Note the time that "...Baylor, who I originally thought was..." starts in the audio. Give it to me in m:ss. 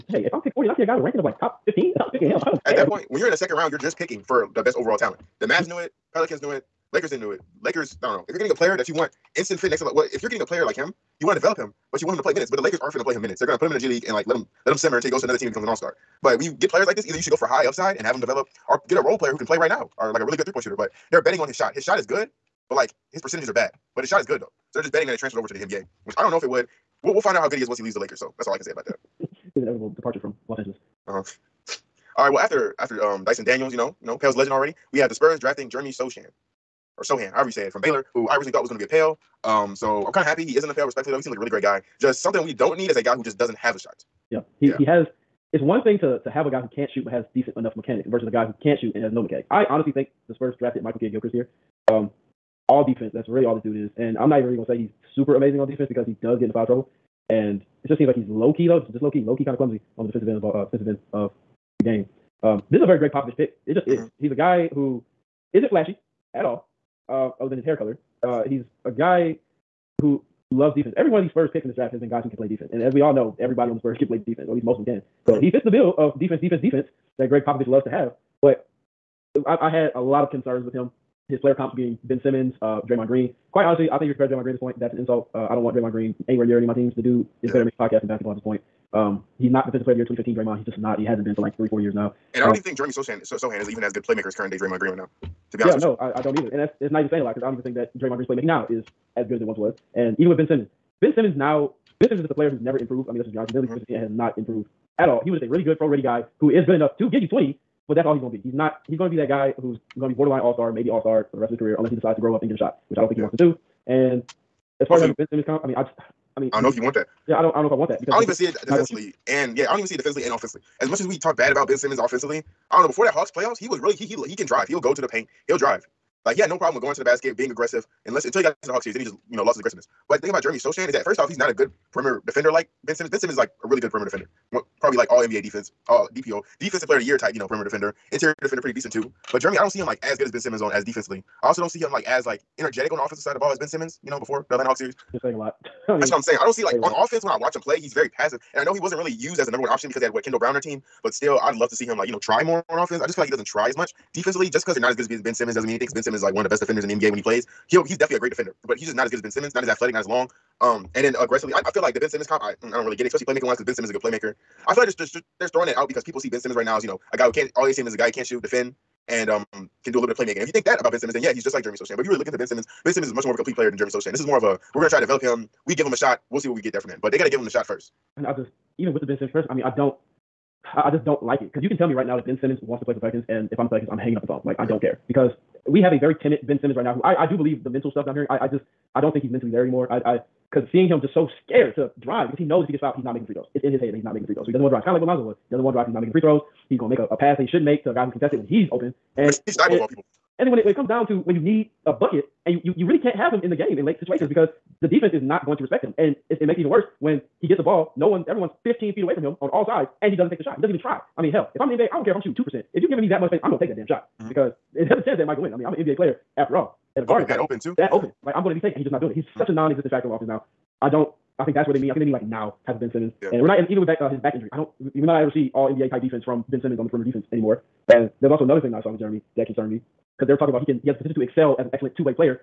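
0:37.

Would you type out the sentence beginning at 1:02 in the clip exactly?
Um, this is a very Gregg Popovich pick.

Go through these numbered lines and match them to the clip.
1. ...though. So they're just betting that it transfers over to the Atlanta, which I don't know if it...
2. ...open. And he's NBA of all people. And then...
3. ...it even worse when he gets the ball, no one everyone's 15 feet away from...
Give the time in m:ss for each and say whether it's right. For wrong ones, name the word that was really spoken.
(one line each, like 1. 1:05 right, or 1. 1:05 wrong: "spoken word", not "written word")
1. 0:24 wrong: "NBA", not "Atlanta"
2. 3:18 wrong: "Thibault", not "NBA"
3. 3:26 right.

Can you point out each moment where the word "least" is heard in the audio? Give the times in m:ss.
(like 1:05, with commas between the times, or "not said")
1:14, 3:38.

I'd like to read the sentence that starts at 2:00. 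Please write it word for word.
As much as we talk bad about Ben Simmons offensively, I don't know.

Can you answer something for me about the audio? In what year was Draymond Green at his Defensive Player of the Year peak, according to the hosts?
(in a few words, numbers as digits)
2015.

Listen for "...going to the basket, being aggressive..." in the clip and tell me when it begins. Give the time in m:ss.
2:06.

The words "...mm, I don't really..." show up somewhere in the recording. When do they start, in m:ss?
2:42.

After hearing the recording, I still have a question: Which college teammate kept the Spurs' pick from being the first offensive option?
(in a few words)
Kendall Brown.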